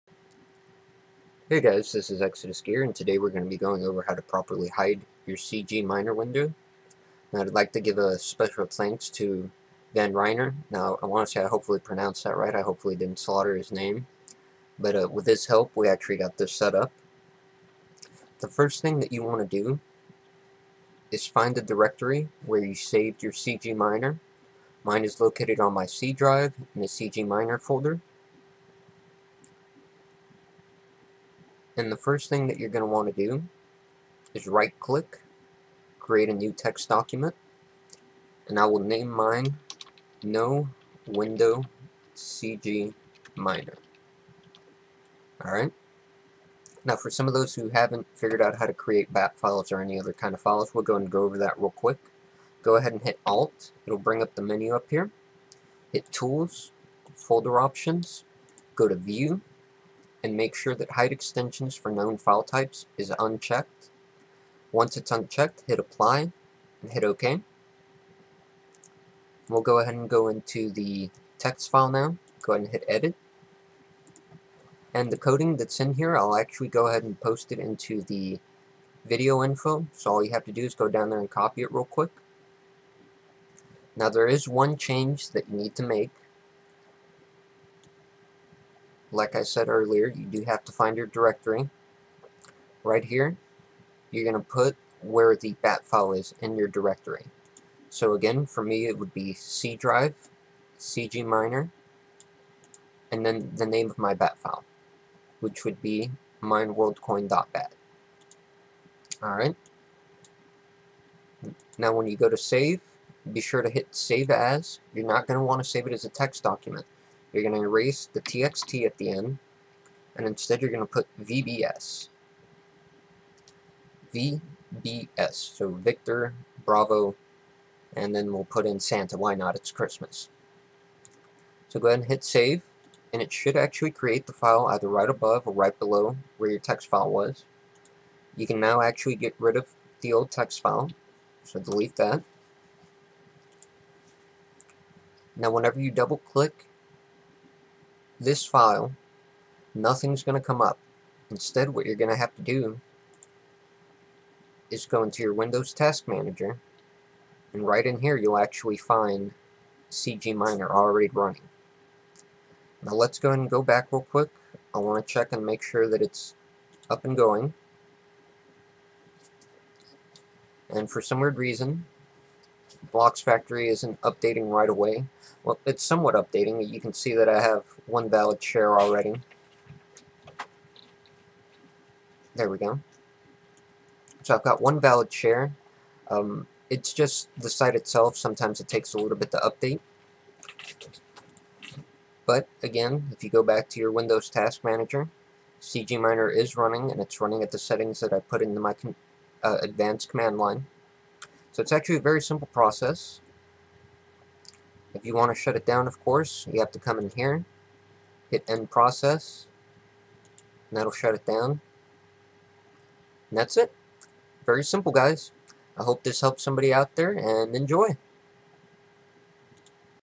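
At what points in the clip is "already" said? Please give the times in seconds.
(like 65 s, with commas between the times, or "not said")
160 s, 178 s.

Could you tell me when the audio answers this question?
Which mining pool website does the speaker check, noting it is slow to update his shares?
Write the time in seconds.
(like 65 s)
172 s.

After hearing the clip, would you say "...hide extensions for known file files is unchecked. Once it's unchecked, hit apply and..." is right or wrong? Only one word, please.
wrong.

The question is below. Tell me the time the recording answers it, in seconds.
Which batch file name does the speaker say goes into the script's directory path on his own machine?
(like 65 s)
106 s.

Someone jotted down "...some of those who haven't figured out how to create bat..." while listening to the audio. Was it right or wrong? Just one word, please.
right.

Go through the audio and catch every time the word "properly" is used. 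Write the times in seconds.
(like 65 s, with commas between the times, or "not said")
4 s.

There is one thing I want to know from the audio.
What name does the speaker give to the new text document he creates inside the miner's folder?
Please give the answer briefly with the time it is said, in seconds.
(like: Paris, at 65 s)
No Window CG Miner, at 40 s.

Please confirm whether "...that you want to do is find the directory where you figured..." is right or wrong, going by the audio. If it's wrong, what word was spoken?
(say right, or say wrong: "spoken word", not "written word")
wrong: "saved", not "figured".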